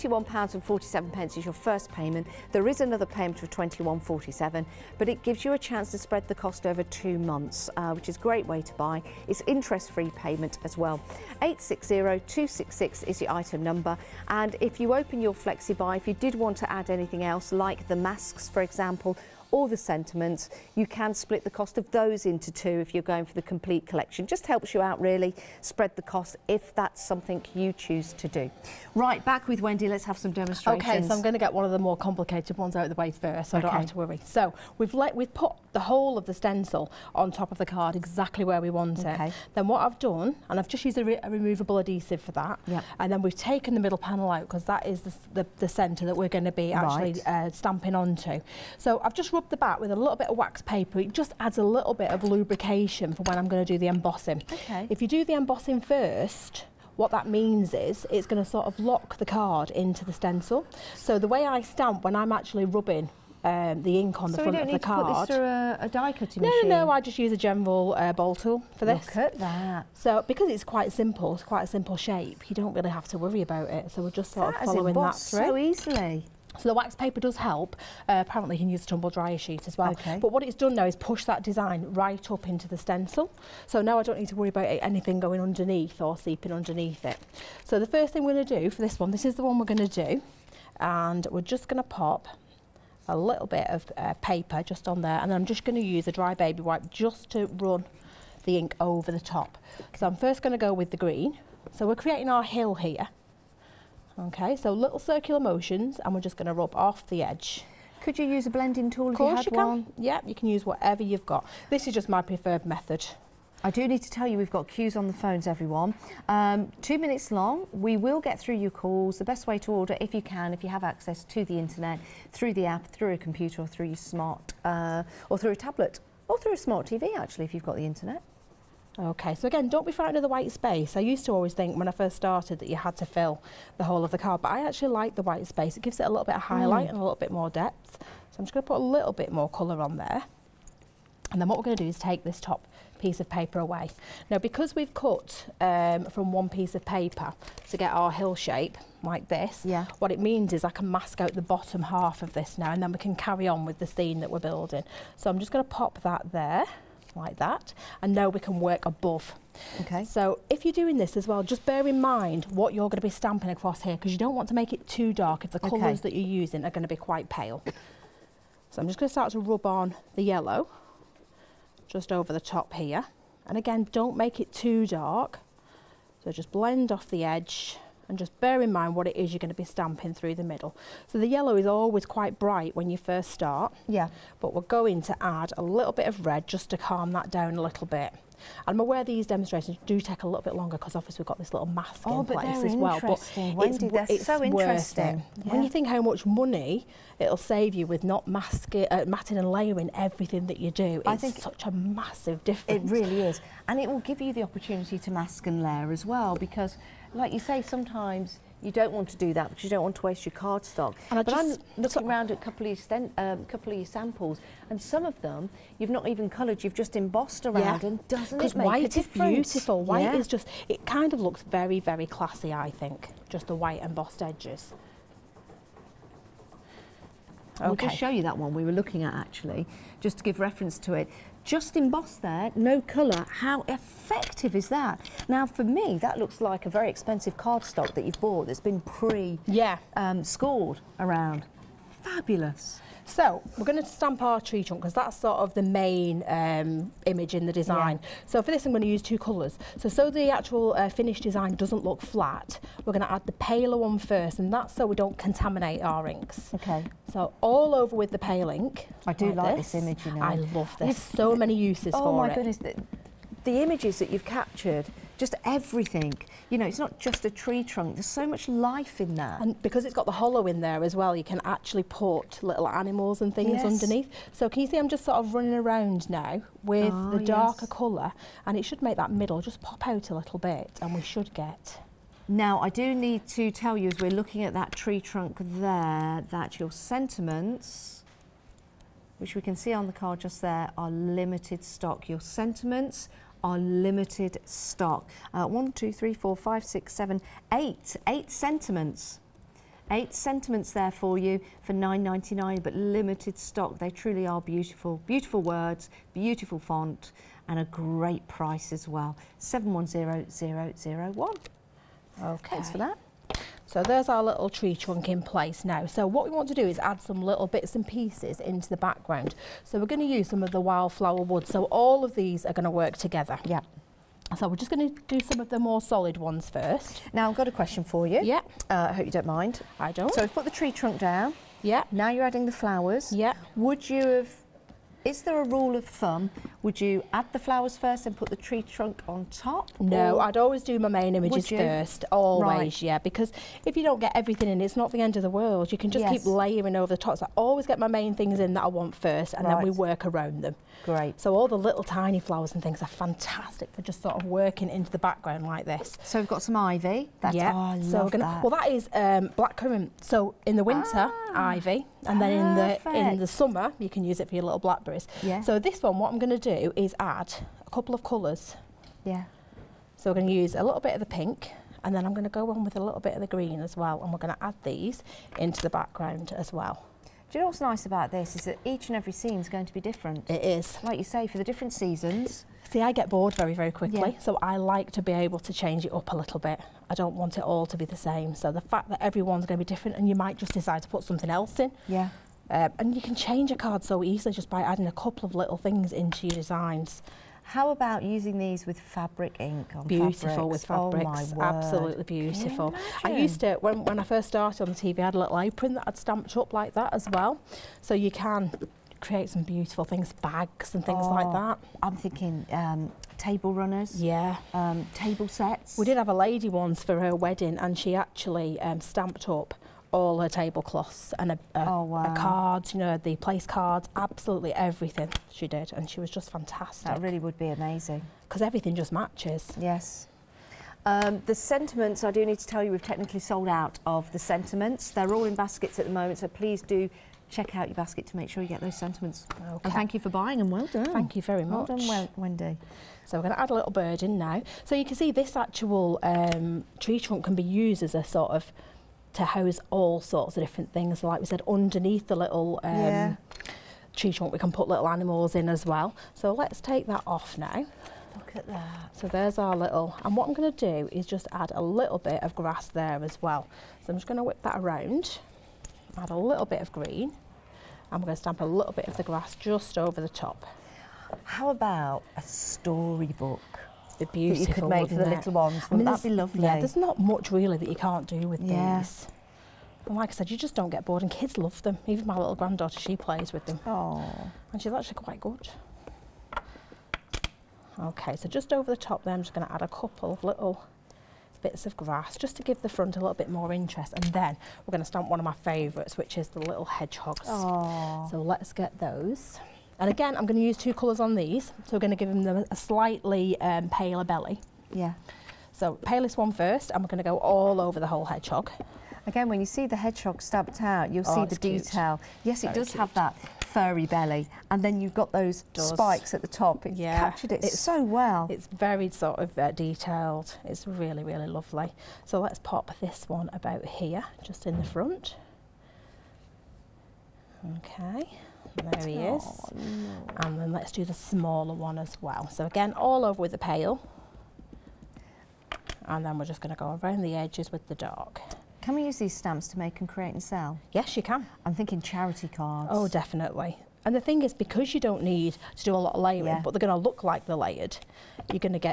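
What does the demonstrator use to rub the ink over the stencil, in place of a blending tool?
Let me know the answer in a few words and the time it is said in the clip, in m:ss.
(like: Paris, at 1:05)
dry baby wipe, at 1:36.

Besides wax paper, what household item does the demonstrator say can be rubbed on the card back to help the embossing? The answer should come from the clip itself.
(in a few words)
tumble dryer sheet.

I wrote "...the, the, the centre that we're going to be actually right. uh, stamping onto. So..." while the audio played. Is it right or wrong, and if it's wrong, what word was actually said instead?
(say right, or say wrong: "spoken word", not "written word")
right.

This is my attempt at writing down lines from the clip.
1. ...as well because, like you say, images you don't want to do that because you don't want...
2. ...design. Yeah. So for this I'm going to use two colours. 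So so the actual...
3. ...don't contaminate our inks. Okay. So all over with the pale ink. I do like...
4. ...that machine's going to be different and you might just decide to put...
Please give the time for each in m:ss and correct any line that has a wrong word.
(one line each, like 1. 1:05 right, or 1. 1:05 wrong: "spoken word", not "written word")
1. 3:25 wrong: "sometimes", not "images"
2. 4:07 right
3. 4:14 right
4. 6:28 wrong: "everyone", not "machine".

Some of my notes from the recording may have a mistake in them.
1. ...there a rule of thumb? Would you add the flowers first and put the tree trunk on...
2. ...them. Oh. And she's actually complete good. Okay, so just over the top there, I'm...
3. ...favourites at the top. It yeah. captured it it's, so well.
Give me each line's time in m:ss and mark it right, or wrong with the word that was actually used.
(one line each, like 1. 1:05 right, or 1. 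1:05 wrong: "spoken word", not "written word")
1. 5:35 right
2. 8:03 wrong: "quite", not "complete"
3. 8:35 wrong: "spikes", not "favourites".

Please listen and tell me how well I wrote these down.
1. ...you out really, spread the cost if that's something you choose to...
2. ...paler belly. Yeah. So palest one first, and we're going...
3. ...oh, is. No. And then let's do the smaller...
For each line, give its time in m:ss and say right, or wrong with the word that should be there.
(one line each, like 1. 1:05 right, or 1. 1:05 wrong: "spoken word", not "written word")
1. 0:24 right
2. 8:23 right
3. 8:48 right.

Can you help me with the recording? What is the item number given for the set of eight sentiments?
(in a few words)
710001.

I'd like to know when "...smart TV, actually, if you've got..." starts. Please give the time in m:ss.
2:06.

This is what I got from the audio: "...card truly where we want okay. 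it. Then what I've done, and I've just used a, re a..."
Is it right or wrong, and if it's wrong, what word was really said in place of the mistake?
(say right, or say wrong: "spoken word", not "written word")
wrong: "exactly", not "truly".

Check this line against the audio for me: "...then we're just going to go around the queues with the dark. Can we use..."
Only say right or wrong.
wrong.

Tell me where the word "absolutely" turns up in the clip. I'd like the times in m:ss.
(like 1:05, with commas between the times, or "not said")
6:41, 7:03.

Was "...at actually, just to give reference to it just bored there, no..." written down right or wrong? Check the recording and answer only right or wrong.
wrong.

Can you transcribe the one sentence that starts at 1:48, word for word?
Could you use a blending tool if you had you one?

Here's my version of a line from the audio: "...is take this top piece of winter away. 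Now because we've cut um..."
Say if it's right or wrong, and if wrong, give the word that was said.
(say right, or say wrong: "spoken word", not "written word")
wrong: "paper", not "winter".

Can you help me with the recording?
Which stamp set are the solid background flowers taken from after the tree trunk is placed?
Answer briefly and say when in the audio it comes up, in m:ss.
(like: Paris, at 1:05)
wildflower wood, at 5:20.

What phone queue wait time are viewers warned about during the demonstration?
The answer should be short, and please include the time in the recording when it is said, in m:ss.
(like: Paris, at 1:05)
2 minutes, at 1:56.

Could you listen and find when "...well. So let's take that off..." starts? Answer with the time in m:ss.
7:35.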